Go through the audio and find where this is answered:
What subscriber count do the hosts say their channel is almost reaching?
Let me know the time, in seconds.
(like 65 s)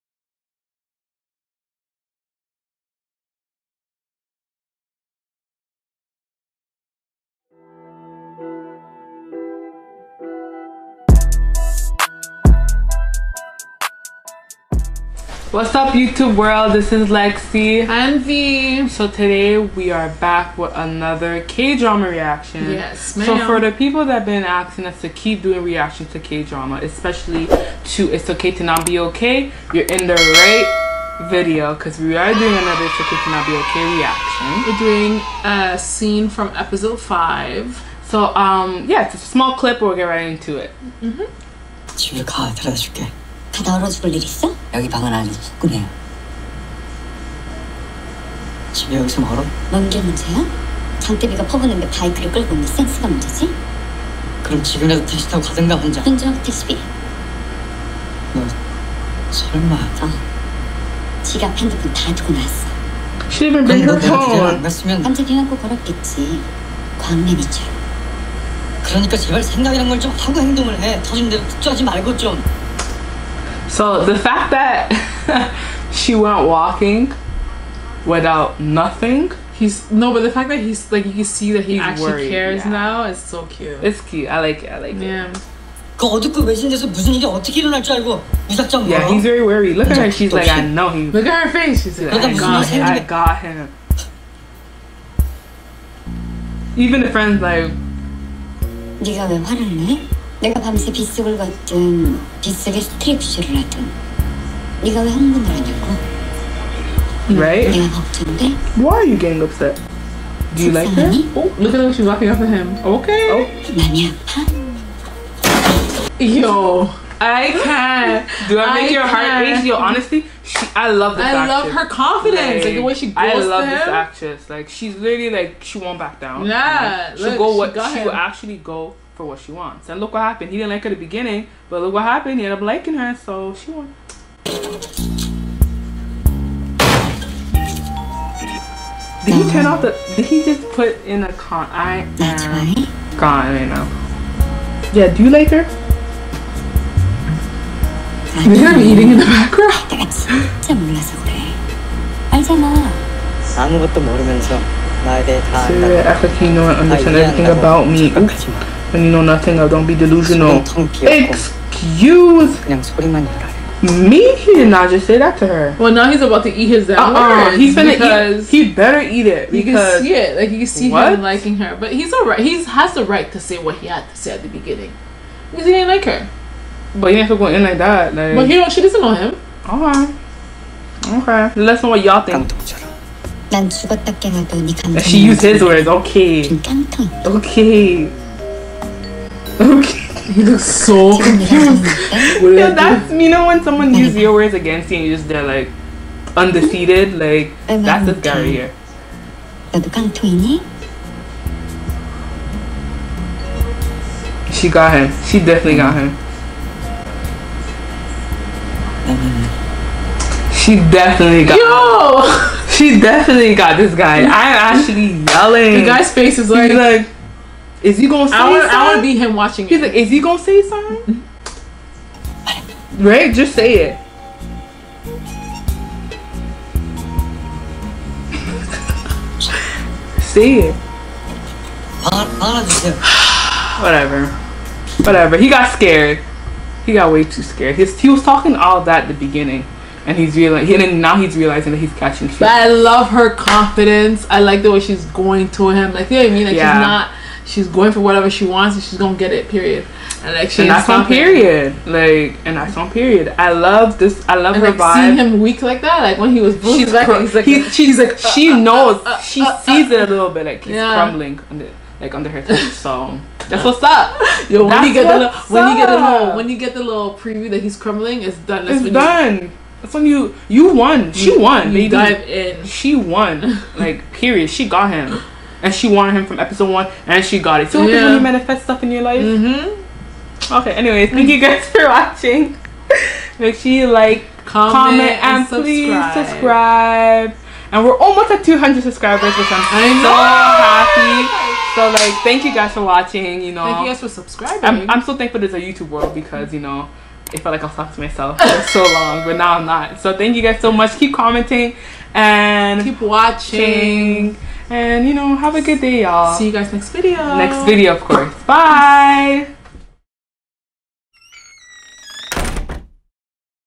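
288 s.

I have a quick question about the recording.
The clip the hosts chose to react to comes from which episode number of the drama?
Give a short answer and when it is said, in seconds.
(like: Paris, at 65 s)
5, at 36 s.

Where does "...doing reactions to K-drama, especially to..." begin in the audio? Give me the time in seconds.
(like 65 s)
25 s.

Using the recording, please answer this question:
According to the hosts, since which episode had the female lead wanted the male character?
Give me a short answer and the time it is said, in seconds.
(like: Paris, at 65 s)
Episode one, at 276 s.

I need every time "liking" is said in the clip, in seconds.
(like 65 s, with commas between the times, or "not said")
132 s, 171 s.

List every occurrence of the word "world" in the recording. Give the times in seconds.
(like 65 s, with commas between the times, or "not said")
16 s, 295 s.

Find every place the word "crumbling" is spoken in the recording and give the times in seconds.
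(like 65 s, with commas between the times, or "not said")
260 s, 267 s.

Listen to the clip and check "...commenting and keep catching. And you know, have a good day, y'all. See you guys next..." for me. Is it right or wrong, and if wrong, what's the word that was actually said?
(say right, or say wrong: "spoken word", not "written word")
wrong: "watching", not "catching".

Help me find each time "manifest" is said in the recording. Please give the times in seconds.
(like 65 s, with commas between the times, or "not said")
278 s.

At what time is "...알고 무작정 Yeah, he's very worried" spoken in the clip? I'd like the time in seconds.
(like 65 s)
87 s.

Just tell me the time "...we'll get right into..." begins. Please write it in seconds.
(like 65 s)
39 s.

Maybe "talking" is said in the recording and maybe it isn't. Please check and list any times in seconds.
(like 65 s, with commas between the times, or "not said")
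238 s, 297 s.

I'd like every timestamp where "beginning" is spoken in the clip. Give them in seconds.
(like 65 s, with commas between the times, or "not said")
131 s, 174 s, 239 s.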